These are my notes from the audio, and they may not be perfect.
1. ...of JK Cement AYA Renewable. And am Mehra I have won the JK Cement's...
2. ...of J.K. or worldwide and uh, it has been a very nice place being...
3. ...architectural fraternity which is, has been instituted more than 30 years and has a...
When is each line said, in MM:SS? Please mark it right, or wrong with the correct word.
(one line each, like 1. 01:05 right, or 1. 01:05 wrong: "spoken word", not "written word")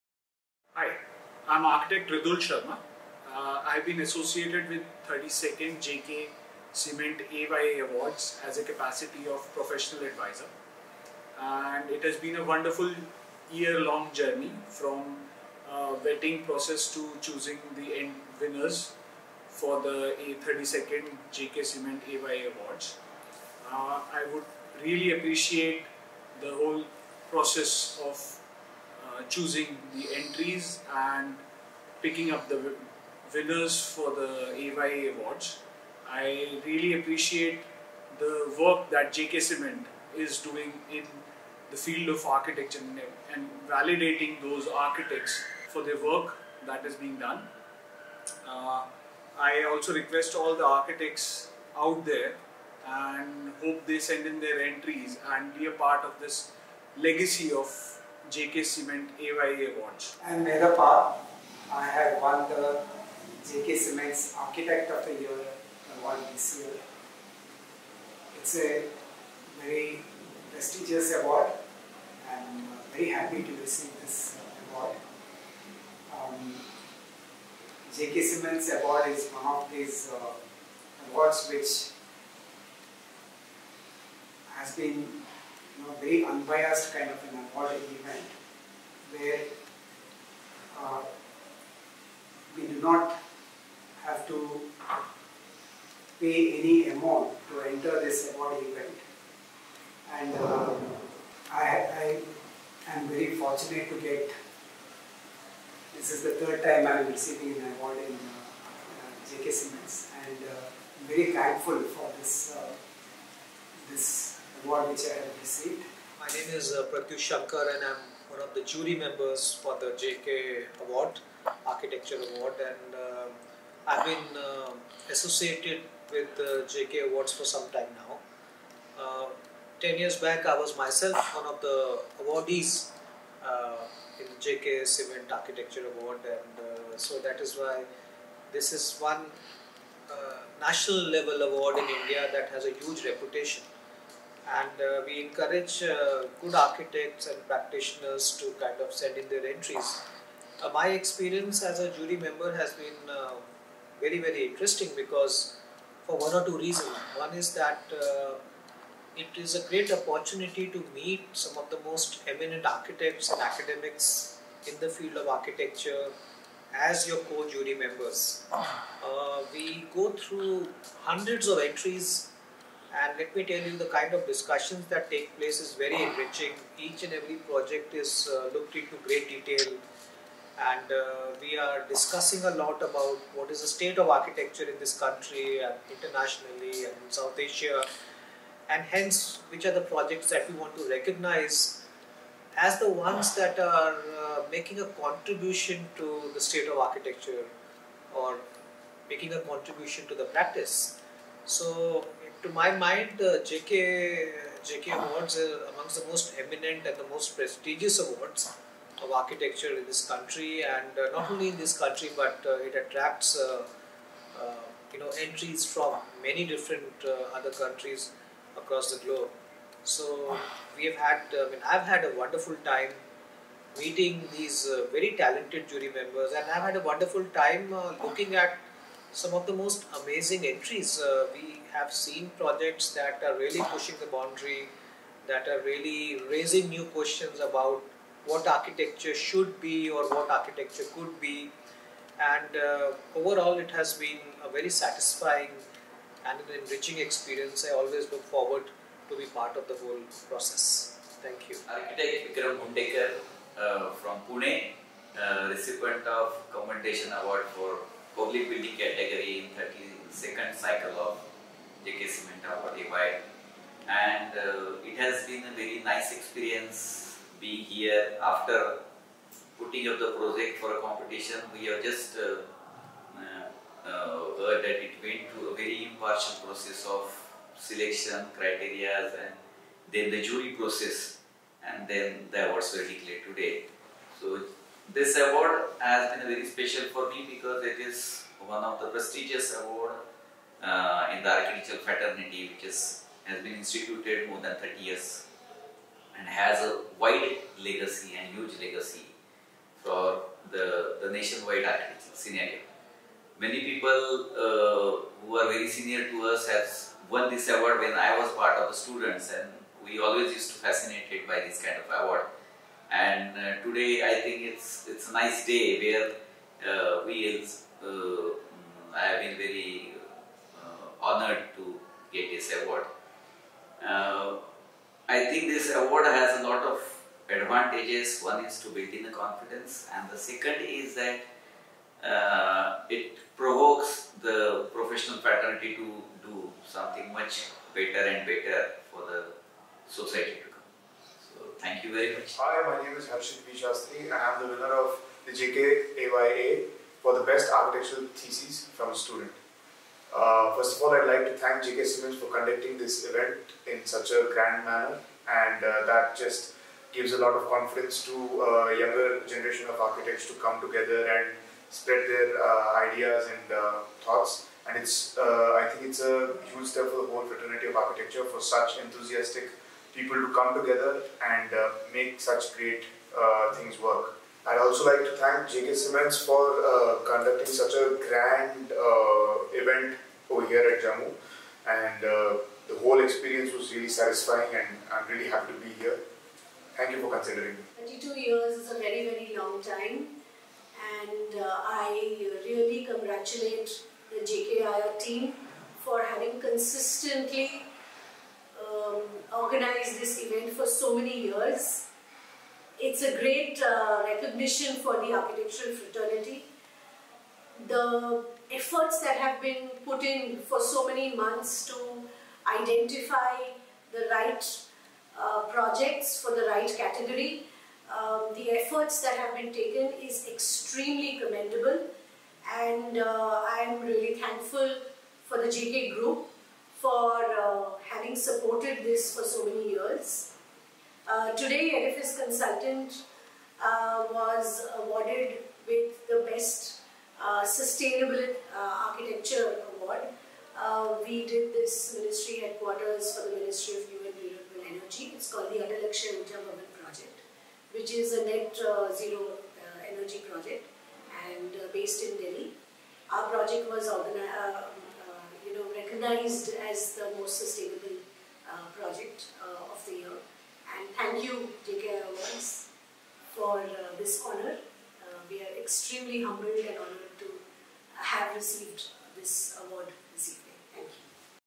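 1. 00:57 wrong: "Awards", not "Renewable"
2. 04:20 wrong: "experience", not "place"
3. 04:51 right.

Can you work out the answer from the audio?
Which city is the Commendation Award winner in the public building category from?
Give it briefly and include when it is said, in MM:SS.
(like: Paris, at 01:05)
Pune, at 04:14.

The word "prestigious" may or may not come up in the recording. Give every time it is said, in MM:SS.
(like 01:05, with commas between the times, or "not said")
01:10, 03:27, 04:48.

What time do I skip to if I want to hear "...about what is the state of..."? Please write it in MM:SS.
03:02.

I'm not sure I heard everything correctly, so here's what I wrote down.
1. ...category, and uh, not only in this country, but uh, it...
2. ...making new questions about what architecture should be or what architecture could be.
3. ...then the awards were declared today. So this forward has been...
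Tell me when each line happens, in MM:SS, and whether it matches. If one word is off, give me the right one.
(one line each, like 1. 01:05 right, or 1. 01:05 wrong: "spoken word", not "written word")
1. 03:30 wrong: "country", not "category"
2. 03:56 wrong: "raising", not "making"
3. 04:41 wrong: "award", not "forward".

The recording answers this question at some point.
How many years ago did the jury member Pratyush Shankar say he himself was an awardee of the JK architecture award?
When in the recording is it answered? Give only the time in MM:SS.
02:09.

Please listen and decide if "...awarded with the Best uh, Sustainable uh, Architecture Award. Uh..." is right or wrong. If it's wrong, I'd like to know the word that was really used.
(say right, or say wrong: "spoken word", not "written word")
right.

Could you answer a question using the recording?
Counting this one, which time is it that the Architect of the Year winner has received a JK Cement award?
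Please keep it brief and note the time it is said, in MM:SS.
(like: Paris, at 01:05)
third, at 01:46.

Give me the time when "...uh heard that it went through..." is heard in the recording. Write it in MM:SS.
04:33.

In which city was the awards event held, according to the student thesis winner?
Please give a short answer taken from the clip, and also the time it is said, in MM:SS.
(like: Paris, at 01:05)
Jammu, at 06:20.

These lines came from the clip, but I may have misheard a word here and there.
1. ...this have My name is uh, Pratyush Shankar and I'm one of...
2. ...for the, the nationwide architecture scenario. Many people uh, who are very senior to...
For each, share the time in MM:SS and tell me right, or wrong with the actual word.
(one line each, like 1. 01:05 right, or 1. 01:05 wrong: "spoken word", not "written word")
1. 01:53 right
2. 04:59 right.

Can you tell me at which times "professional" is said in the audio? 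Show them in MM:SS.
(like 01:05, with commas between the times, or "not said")
00:09, 05:34.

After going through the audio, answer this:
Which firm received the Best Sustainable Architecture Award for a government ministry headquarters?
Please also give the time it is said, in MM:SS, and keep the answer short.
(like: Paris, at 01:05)
Edifice Consultant, at 07:11.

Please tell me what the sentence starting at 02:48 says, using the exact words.
Uh, we go through hundreds of entries and let me tell you, the kind of discussions that take place is very enriching.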